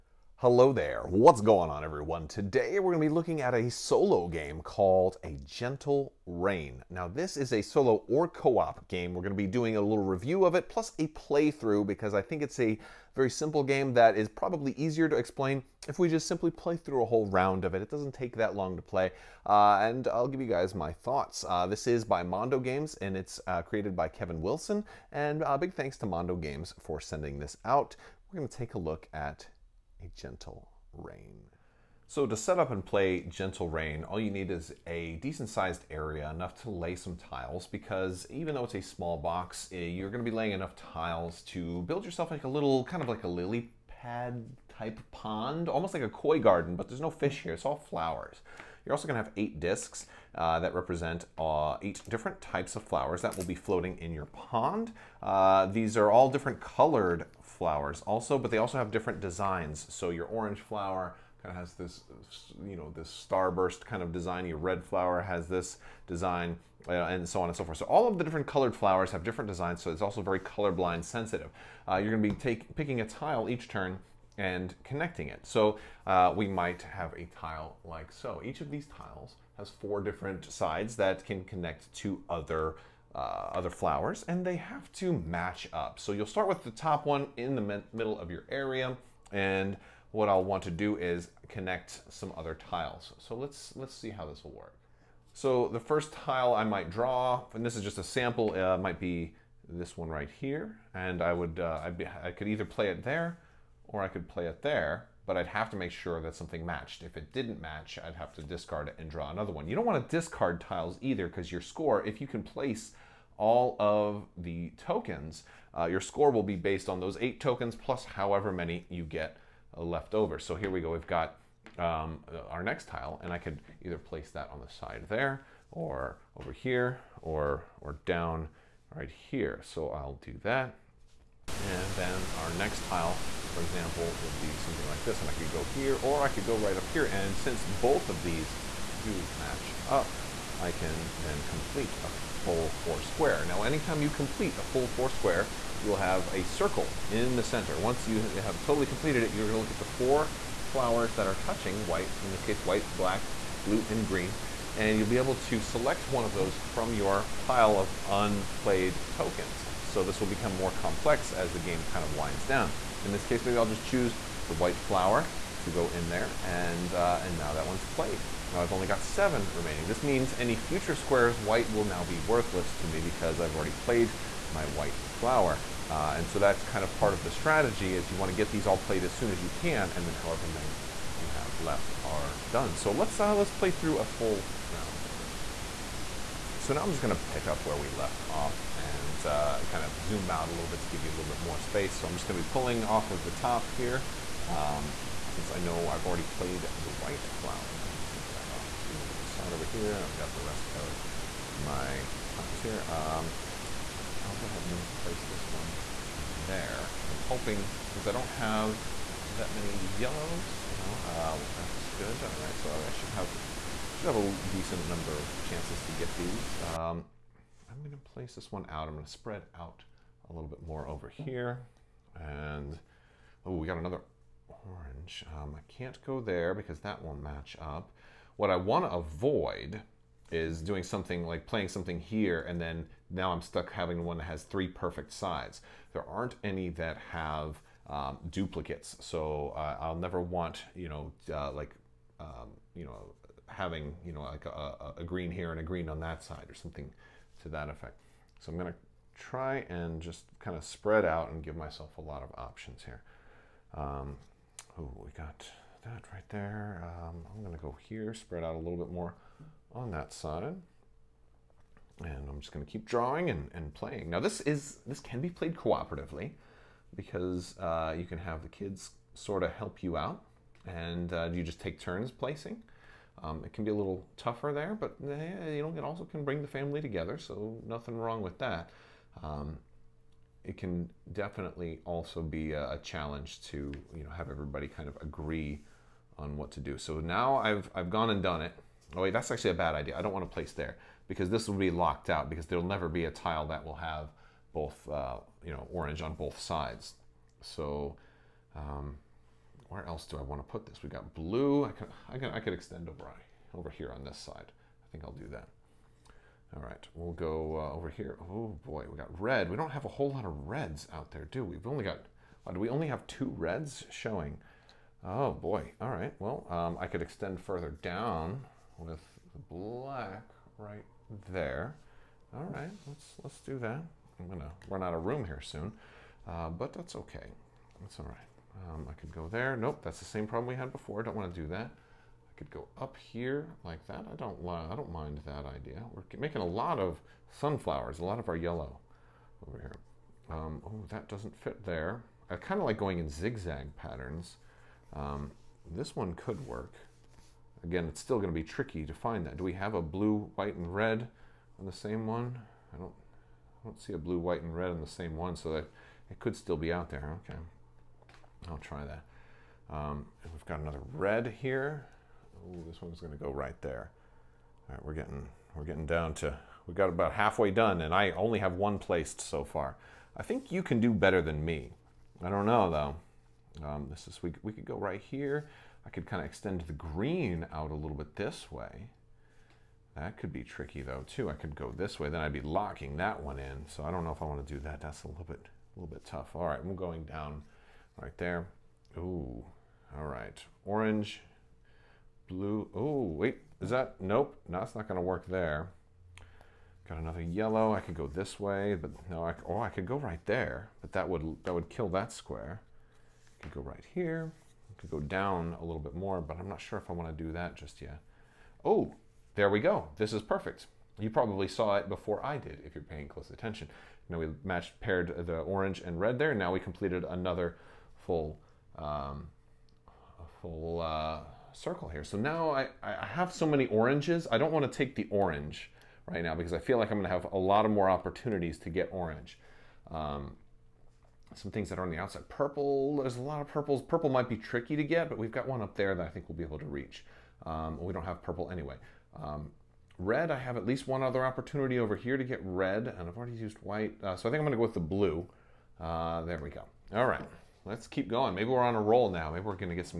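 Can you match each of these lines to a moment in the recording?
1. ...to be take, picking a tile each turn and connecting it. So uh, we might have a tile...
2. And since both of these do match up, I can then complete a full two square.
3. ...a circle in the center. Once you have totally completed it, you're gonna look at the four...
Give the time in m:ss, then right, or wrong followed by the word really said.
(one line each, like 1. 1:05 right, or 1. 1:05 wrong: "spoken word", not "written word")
1. 1:12 right
2. 2:17 wrong: "four", not "two"
3. 2:26 right.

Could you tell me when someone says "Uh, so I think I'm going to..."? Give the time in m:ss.
7:24.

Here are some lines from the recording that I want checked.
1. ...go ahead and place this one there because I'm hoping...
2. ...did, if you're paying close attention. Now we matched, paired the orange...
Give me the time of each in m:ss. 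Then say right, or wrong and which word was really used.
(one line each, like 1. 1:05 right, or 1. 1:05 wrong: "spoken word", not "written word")
1. 3:24 right
2. 6:52 right.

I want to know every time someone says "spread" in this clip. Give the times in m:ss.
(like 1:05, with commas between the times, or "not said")
3:39, 4:10, 4:18.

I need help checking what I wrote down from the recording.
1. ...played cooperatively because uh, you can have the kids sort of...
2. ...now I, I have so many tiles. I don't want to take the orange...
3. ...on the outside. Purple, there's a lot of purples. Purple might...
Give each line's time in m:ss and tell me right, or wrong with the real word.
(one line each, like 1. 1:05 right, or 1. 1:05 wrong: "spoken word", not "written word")
1. 4:25 right
2. 7:02 wrong: "oranges", not "tiles"
3. 7:11 right.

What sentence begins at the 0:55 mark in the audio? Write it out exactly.
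Uh, these are all different colored flowers also, but they also have different designs.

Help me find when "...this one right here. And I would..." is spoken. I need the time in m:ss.
1:39.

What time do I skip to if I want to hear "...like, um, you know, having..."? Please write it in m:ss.
4:01.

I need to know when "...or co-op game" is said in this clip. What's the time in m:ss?
0:08.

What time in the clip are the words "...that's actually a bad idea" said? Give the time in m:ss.
4:49.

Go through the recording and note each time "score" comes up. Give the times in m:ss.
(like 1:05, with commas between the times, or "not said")
1:51, 1:56.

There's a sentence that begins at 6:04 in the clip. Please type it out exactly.
All right, we're getting, we're getting down to, we got about halfway done, and I only have one placed so far.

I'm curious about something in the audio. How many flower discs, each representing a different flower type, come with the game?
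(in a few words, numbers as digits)
8.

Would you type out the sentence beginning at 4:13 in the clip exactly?
Um, Oh, we got that right there.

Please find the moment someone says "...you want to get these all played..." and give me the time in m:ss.
2:58.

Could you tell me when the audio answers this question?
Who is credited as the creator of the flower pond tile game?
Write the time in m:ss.
0:24.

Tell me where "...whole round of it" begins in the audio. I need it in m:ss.
0:17.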